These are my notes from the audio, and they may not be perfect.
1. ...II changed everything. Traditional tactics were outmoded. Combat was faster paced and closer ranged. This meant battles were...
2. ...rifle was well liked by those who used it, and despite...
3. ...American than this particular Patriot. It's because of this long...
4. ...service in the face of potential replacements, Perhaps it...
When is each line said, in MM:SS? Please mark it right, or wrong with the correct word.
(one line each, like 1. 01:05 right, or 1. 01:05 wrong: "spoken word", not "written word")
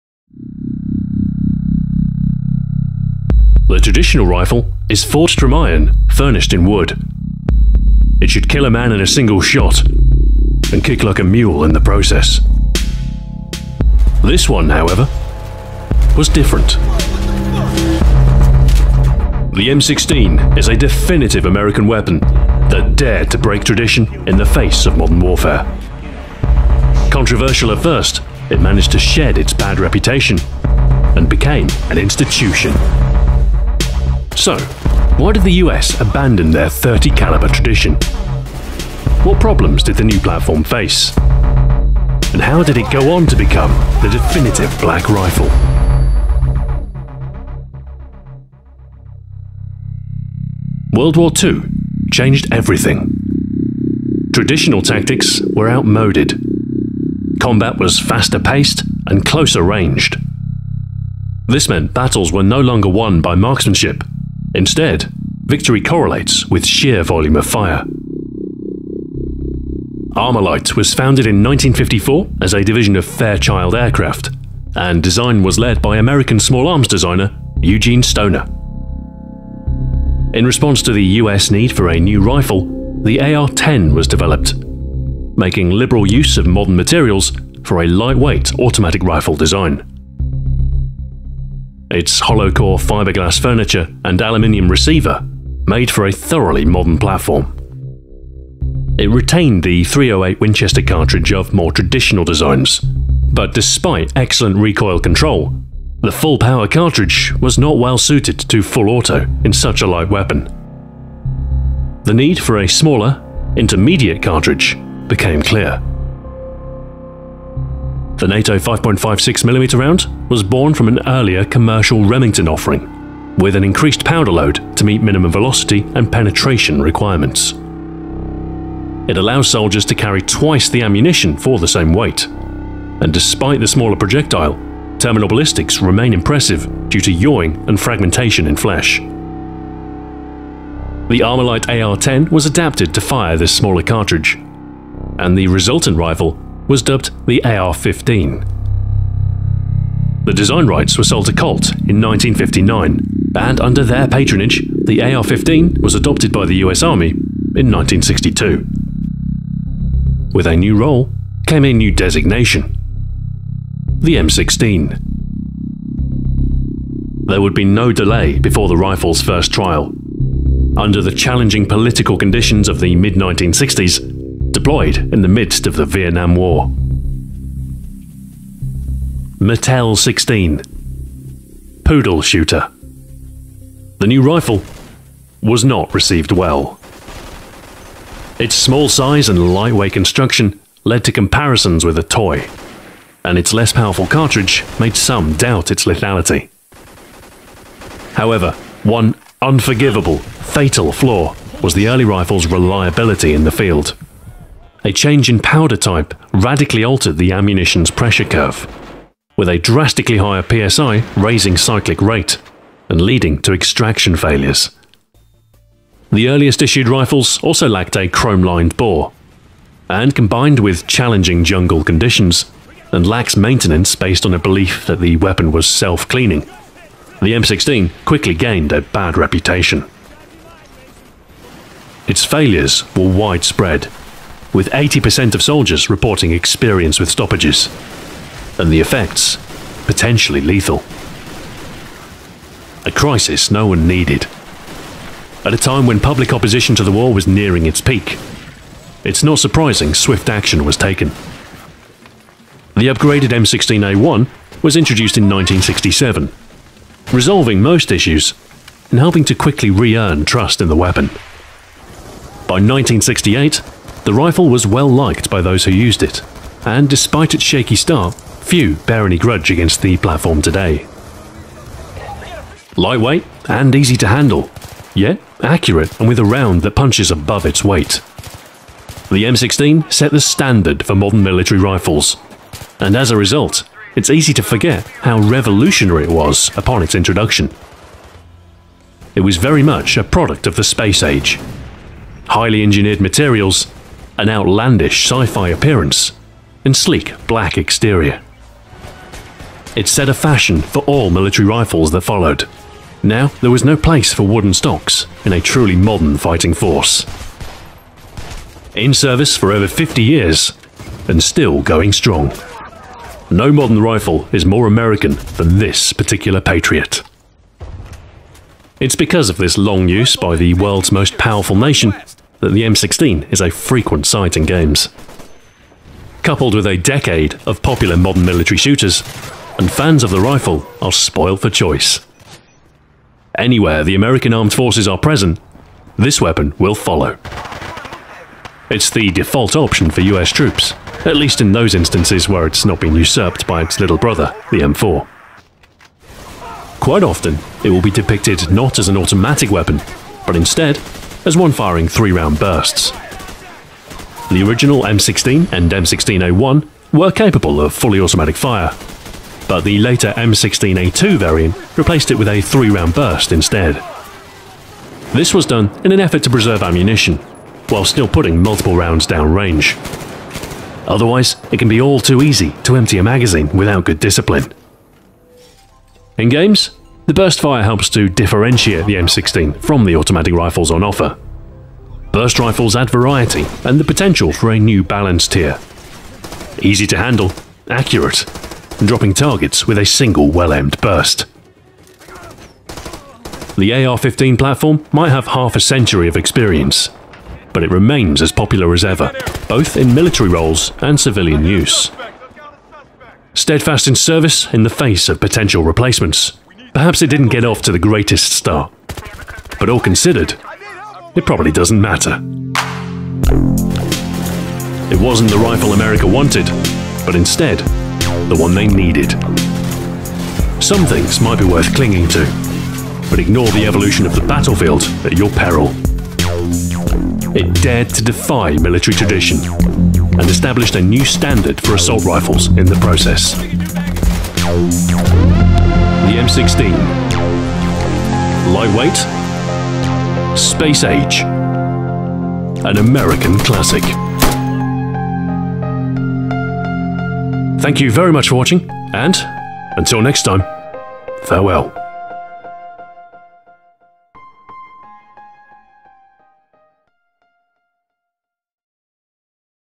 1. 00:51 right
2. 04:24 right
3. 05:14 right
4. 06:43 right.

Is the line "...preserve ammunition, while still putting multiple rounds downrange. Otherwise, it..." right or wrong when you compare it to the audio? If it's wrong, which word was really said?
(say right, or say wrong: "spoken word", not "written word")
right.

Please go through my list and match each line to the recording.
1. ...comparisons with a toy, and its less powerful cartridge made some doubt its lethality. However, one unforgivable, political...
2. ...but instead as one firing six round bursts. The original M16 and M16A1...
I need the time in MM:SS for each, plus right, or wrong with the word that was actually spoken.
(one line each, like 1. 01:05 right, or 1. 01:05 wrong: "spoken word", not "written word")
1. 03:11 wrong: "fatal", not "political"
2. 05:50 wrong: "three", not "six".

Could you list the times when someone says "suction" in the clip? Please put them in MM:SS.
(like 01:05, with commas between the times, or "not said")
not said.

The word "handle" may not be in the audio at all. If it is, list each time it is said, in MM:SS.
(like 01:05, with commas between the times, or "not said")
04:34, 06:26.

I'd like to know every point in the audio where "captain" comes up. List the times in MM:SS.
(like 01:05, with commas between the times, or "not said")
not said.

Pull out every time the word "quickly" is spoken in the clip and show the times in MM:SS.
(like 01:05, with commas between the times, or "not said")
03:48, 04:19.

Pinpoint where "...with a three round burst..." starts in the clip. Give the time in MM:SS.
06:02.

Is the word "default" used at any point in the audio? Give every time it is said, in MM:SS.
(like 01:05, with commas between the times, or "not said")
05:39.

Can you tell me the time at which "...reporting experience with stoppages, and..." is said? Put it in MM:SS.
03:55.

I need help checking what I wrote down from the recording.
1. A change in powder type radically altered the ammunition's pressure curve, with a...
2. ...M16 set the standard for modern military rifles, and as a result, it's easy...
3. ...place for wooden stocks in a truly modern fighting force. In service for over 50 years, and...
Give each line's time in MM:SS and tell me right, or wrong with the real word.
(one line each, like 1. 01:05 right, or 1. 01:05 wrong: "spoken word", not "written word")
1. 03:24 right
2. 04:39 right
3. 05:03 right.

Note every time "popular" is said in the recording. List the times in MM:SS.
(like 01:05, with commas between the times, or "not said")
05:27, 06:38.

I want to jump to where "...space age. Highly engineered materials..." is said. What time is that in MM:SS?
04:50.